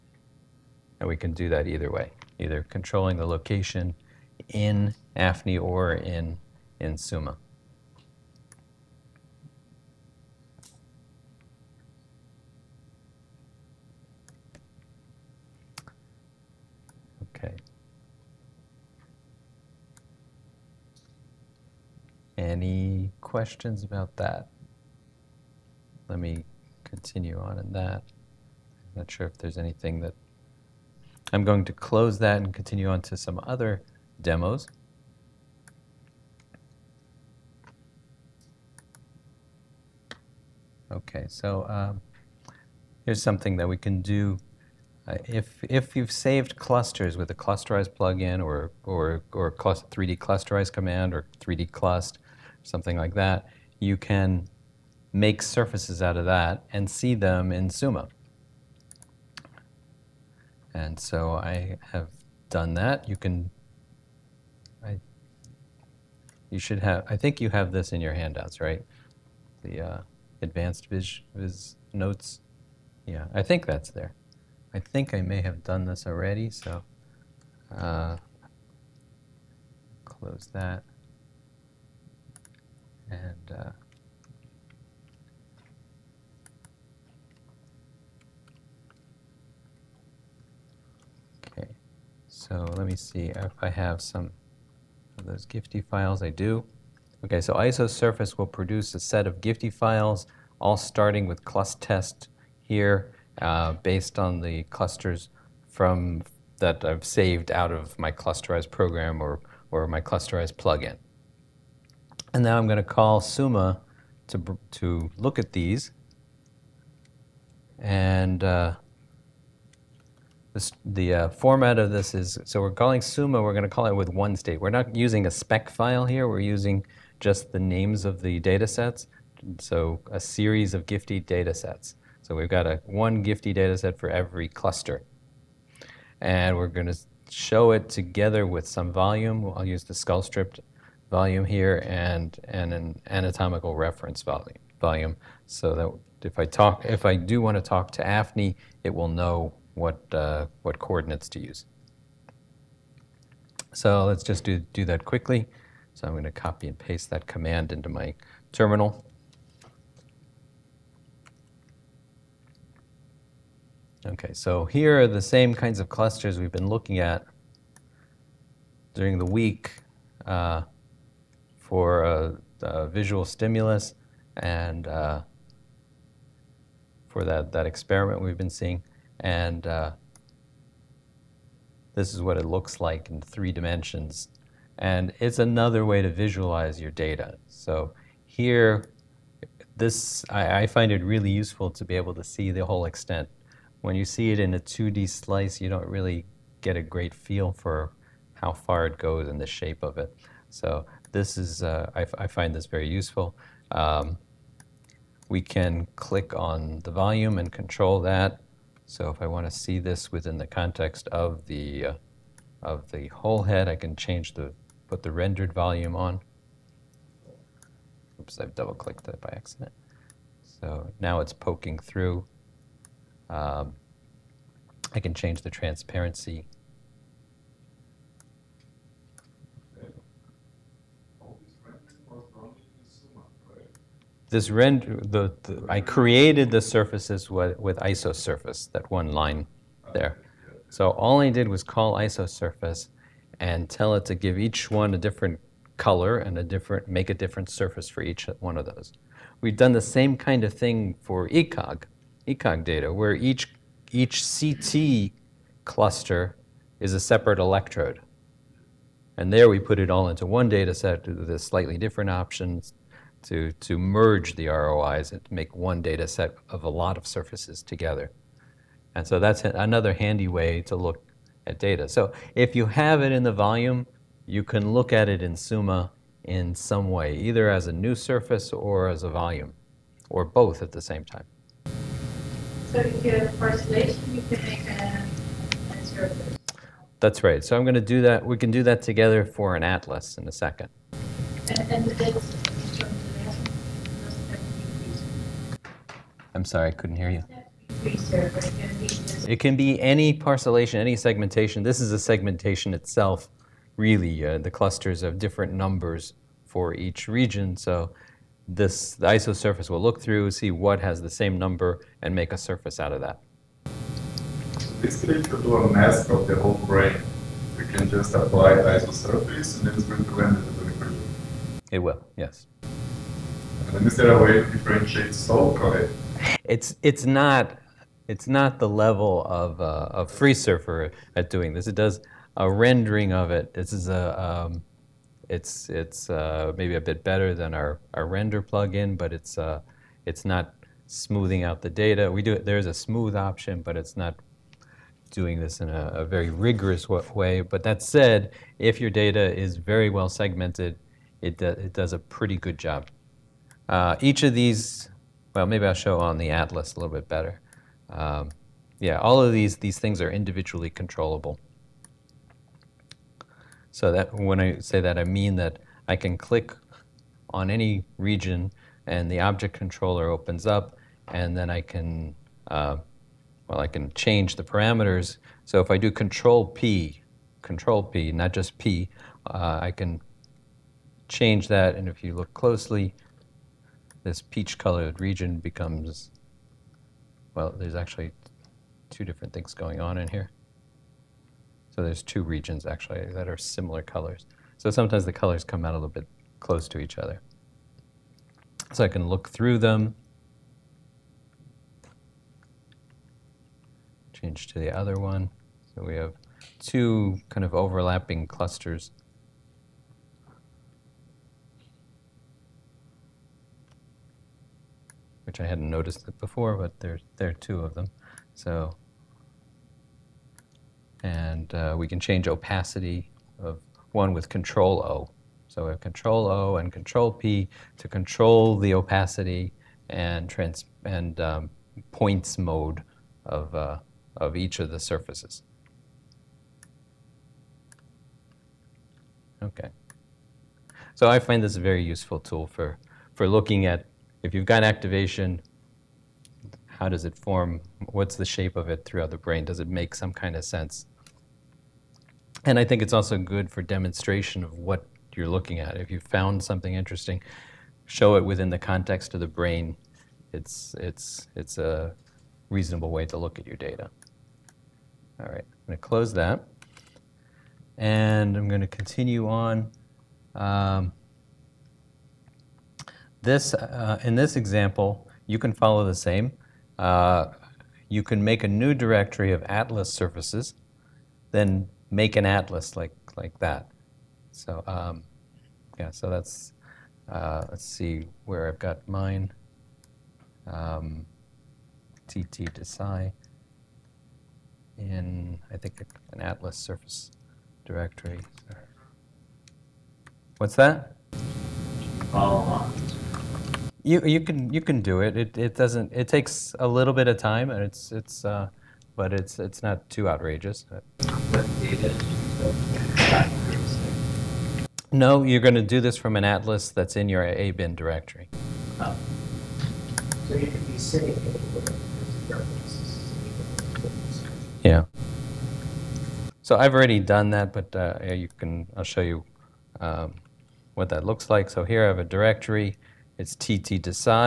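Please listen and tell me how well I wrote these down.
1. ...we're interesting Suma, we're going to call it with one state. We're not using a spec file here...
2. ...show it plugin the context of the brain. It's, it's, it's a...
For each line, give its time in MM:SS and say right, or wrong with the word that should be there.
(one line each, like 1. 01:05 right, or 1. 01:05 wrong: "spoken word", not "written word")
1. 02:02 wrong: "calling", not "interesting"
2. 07:37 wrong: "within", not "plugin".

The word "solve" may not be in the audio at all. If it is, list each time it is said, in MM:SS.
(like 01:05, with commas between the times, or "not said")
05:25.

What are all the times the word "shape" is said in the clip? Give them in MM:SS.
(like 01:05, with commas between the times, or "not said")
03:19, 07:28.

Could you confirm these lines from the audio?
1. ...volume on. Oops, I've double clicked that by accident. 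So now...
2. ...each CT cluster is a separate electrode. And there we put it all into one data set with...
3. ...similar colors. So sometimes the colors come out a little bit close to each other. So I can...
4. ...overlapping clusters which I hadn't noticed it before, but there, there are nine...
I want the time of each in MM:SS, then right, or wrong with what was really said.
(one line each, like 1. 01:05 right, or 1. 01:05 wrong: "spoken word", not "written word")
1. 03:35 right
2. 04:13 right
3. 06:33 right
4. 06:47 wrong: "two", not "nine".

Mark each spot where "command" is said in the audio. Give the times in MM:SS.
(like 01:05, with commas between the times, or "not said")
00:50, 02:37.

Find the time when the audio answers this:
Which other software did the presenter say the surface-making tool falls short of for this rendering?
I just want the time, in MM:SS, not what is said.
05:30.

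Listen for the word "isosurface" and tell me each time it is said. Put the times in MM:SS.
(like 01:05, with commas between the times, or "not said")
01:37, 03:57, 04:01, 05:09, 05:18.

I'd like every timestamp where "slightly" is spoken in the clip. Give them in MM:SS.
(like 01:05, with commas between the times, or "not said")
04:21.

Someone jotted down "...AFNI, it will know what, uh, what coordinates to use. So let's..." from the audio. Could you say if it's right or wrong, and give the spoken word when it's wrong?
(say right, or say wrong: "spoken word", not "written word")
right.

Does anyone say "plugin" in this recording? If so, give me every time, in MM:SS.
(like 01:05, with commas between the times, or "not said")
00:47, 01:50, 05:38.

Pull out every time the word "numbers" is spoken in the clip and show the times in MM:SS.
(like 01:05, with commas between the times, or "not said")
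05:05, 05:11.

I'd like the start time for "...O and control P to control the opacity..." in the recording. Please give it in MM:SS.
07:06.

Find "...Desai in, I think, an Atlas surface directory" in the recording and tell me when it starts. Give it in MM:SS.
08:12.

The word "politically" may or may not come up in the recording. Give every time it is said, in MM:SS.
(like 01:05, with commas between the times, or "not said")
not said.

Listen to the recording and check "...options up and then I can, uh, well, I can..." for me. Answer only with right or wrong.
wrong.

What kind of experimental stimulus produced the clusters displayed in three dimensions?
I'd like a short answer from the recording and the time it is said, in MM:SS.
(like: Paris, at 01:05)
visual stimulus, at 02:52.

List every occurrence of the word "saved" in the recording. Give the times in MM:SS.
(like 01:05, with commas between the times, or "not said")
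00:46, 01:47.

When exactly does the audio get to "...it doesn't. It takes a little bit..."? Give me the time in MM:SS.
08:25.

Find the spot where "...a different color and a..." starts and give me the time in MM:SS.
04:04.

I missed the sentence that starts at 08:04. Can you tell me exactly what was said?
So, um, yeah, so that's, uh, let's see where I've got mine.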